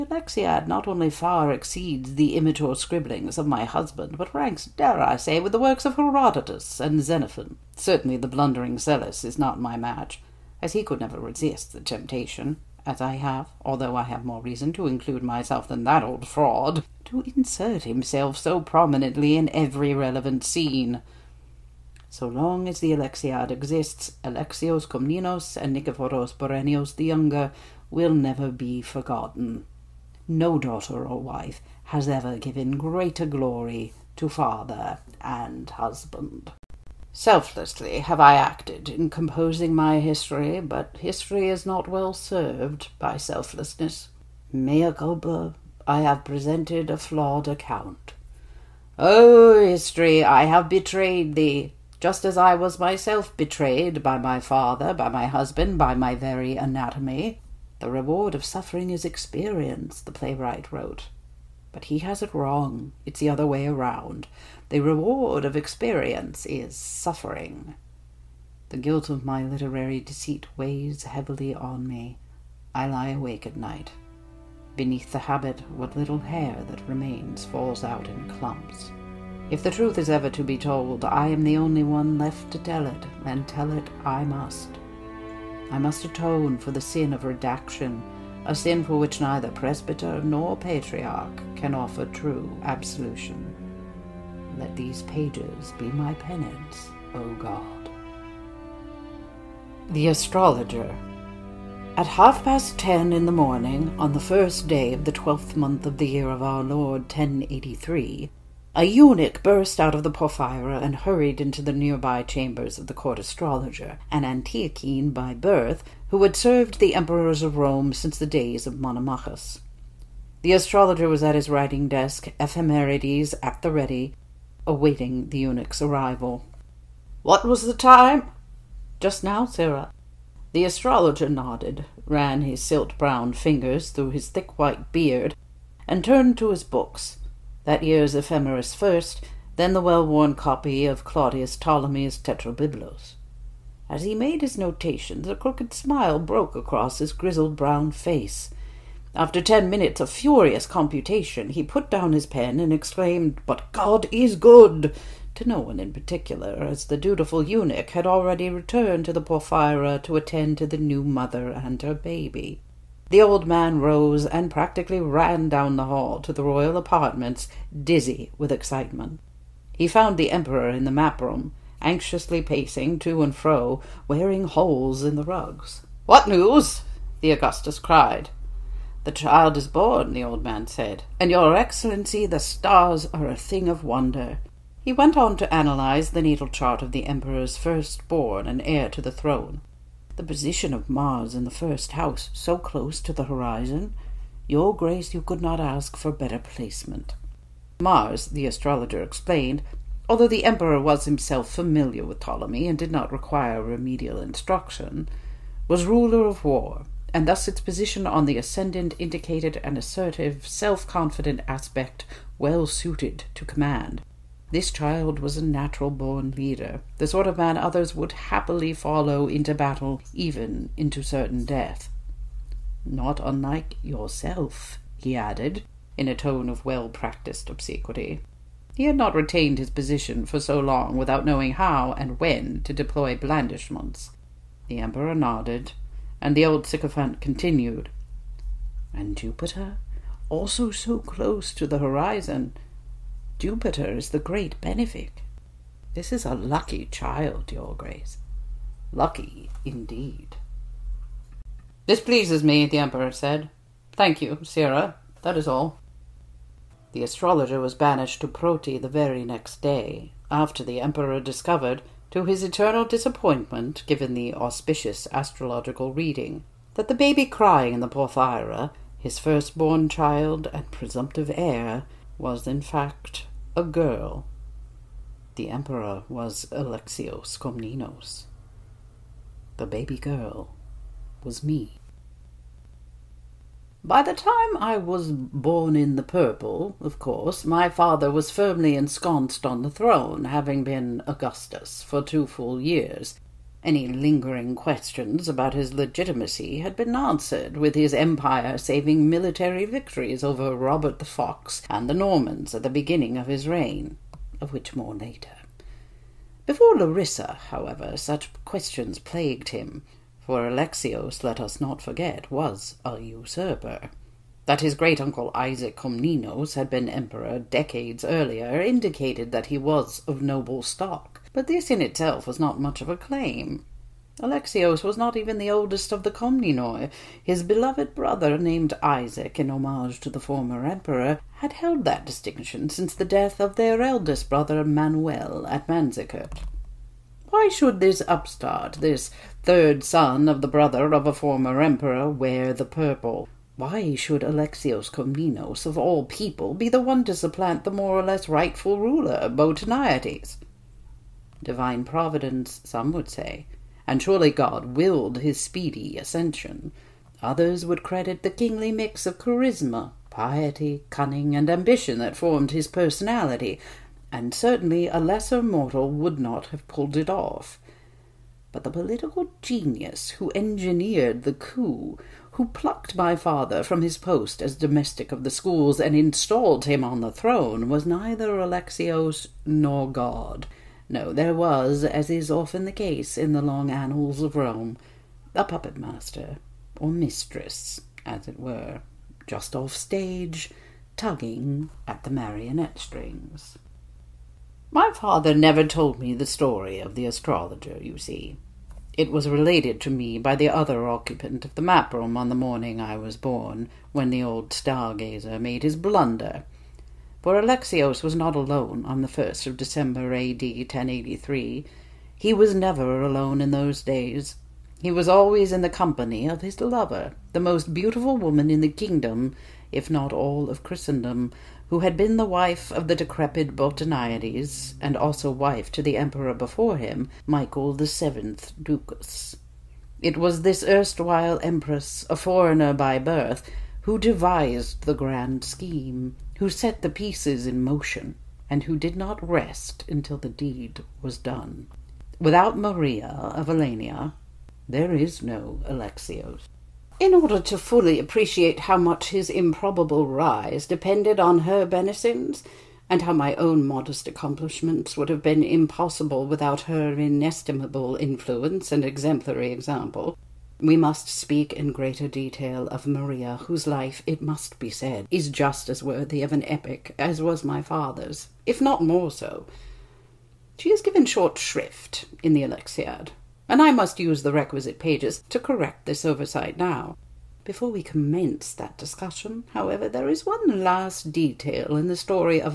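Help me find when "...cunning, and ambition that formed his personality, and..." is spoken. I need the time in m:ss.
6:00.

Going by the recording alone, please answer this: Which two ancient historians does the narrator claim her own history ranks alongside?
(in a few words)
Herodotus and Xenophon.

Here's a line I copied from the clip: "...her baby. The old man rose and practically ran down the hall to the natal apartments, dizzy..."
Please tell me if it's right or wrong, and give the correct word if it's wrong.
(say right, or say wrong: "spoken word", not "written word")
wrong: "royal", not "natal".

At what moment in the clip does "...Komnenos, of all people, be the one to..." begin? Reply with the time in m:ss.
5:44.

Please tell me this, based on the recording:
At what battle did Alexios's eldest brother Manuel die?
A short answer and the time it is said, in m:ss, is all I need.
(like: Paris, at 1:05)
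Manzikert, at 5:35.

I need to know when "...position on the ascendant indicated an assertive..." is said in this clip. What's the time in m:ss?
3:27.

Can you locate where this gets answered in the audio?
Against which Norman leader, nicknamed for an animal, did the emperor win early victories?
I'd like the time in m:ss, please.
5:00.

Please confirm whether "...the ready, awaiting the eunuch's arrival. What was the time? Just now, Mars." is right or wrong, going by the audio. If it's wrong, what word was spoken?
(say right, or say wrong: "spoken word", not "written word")
wrong: "Sirrah", not "Mars".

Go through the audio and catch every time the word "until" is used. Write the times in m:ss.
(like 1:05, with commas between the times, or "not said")
7:19.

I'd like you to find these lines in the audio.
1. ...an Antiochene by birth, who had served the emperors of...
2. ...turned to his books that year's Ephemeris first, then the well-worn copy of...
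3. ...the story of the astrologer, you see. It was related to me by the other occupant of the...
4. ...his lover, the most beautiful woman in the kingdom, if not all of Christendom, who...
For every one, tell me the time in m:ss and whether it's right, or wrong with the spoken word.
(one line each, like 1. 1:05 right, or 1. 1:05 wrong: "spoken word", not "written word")
1. 1:54 right
2. 2:16 right
3. 6:36 right
4. 6:56 right.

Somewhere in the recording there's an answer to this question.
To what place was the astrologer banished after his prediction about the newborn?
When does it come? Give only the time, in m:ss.
4:18.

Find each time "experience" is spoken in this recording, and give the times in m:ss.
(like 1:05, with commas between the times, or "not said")
0:59, 1:05.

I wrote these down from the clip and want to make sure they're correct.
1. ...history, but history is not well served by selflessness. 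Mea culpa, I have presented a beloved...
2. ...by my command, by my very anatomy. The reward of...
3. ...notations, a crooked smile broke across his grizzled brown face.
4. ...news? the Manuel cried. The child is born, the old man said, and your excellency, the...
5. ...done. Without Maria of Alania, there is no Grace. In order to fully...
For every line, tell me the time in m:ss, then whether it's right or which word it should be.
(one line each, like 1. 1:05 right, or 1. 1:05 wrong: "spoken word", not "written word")
1. 0:39 wrong: "flawed", not "beloved"
2. 0:54 wrong: "husband", not "command"
3. 2:24 right
4. 2:56 wrong: "Augustus", not "Manuel"
5. 7:21 wrong: "Alexios", not "Grace".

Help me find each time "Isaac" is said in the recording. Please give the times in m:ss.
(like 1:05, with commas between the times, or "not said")
5:15, 5:28.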